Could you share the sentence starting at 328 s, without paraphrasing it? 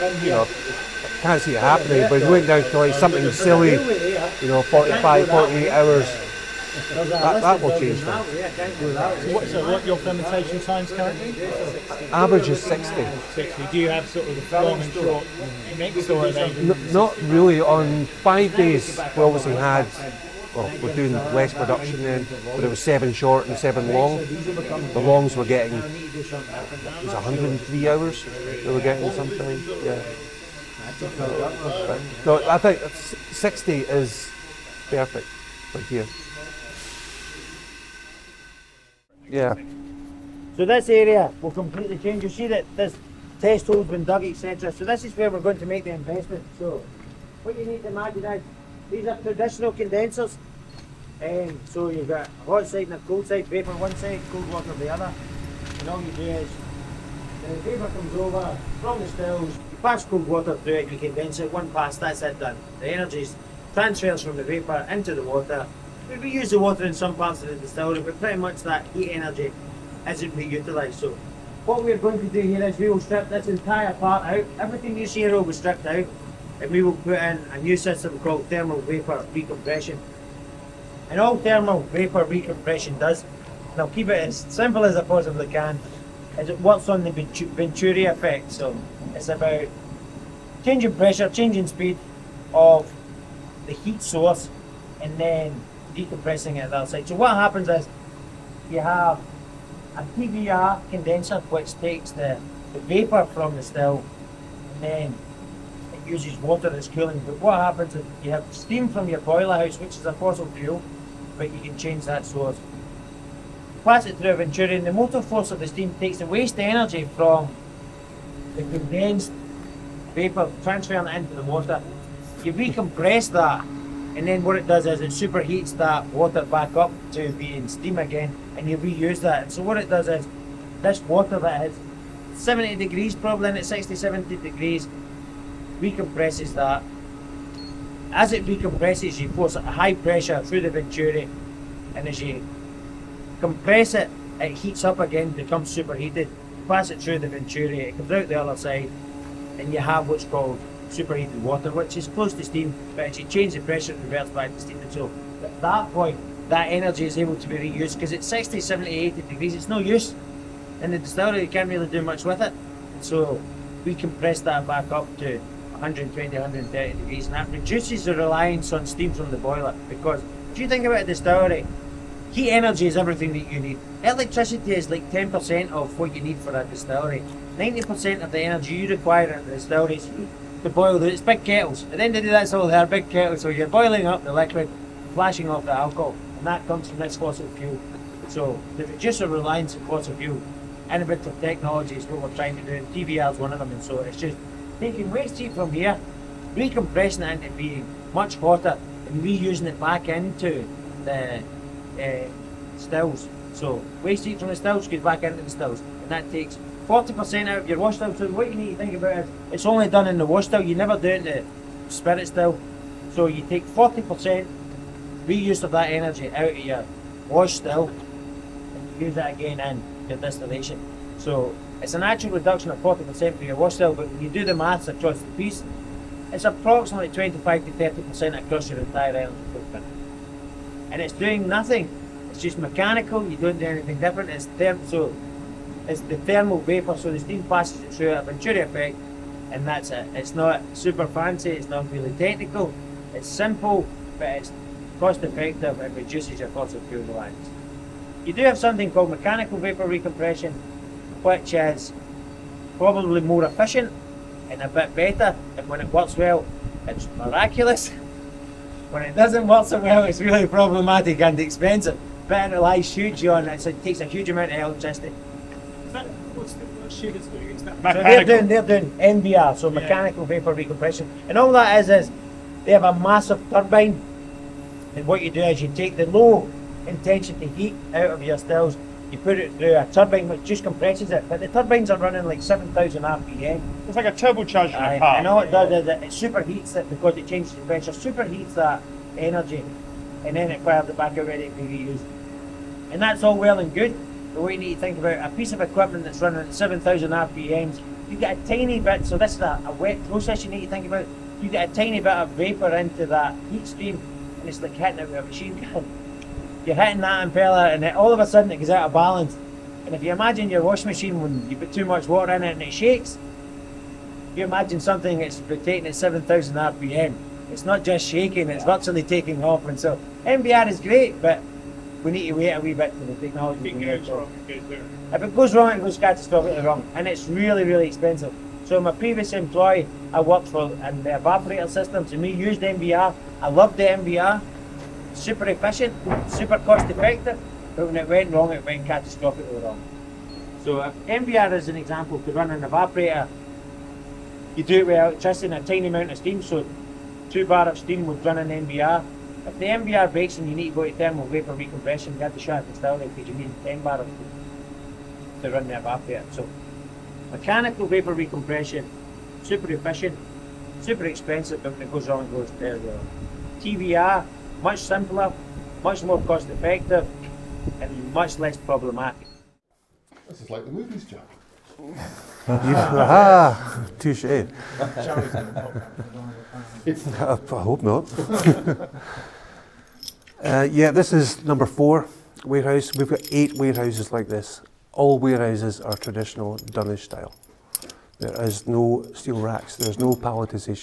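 So my previous employee, I worked for in the evaporator systems, and we used MVR.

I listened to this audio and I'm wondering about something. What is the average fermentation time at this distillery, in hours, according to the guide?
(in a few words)
60.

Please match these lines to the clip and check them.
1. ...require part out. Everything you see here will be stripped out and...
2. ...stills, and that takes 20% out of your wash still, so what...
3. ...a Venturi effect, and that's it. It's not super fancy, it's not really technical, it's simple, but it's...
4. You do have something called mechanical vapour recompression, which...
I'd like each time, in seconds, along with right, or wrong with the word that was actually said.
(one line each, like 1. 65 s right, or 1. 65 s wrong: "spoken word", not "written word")
1. 73 s wrong: "entire", not "require"
2. 205 s wrong: "40", not "20"
3. 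238 s right
4. 248 s right.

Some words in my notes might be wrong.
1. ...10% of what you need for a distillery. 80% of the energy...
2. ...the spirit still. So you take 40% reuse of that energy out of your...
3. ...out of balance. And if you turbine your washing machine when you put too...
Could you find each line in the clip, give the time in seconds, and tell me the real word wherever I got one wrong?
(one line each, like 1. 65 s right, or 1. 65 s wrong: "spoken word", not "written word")
1. 175 s wrong: "90", not "80"
2. 211 s right
3. 308 s wrong: "imagine", not "turbine".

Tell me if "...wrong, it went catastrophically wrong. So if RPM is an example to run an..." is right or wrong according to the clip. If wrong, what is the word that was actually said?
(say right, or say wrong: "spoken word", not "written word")
wrong: "MVR", not "RPM".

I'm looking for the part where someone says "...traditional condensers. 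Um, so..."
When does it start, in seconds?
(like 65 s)
49 s.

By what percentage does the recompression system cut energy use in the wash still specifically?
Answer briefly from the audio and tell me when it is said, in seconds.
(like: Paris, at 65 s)
40%, at 221 s.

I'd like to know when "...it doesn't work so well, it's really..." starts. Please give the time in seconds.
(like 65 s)
259 s.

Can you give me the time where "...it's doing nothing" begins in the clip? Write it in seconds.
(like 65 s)
231 s.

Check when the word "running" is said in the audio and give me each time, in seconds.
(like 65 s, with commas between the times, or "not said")
281 s, 296 s.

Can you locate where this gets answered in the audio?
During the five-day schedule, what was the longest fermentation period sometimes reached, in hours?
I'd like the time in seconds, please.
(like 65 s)
25 s.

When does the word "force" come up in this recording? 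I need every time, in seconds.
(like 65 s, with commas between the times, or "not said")
115 s, 139 s.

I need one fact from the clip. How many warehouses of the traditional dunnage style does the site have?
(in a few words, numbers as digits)
8.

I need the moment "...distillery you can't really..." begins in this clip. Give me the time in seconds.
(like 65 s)
160 s.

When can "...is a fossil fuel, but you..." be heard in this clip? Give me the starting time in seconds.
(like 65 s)
109 s.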